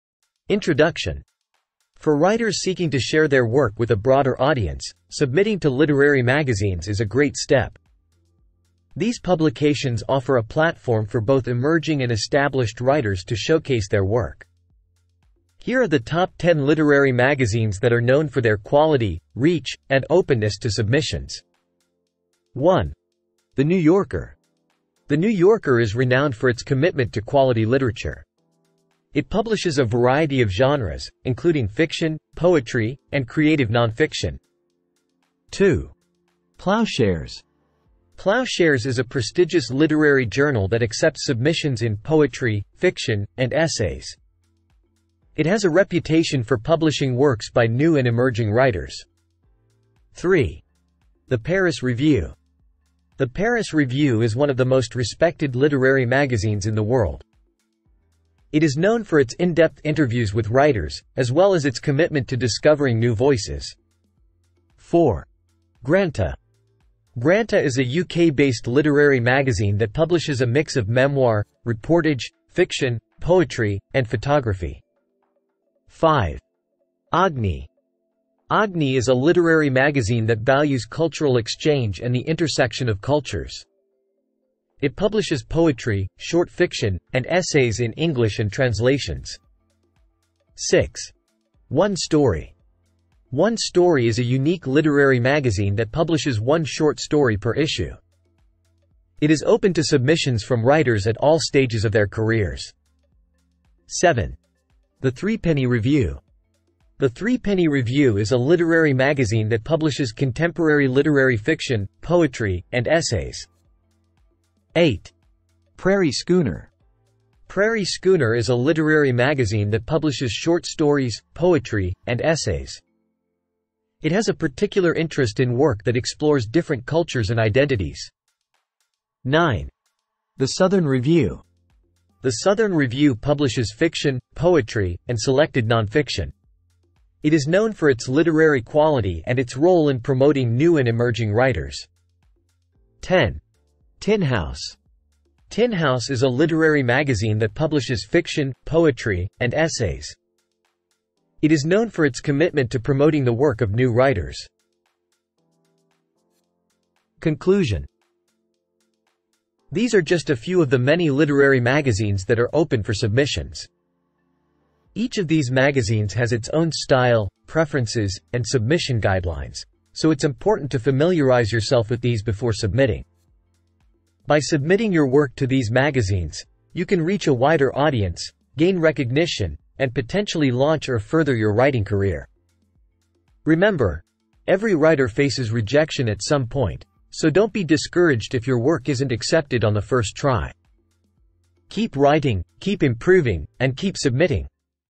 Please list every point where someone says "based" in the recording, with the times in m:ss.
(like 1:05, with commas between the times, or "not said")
1:08.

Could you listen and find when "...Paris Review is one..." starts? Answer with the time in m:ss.
0:53.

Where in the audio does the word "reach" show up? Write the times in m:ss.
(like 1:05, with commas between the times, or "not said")
0:19, 2:57.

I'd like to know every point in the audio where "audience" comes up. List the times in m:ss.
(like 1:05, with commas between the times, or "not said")
0:04, 2:57.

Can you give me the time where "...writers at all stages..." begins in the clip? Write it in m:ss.
1:40.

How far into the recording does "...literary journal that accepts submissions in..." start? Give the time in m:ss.
0:39.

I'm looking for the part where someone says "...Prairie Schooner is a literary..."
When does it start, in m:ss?
1:57.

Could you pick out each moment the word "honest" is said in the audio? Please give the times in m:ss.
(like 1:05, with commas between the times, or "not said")
not said.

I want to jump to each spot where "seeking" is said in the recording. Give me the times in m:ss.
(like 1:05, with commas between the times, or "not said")
0:02.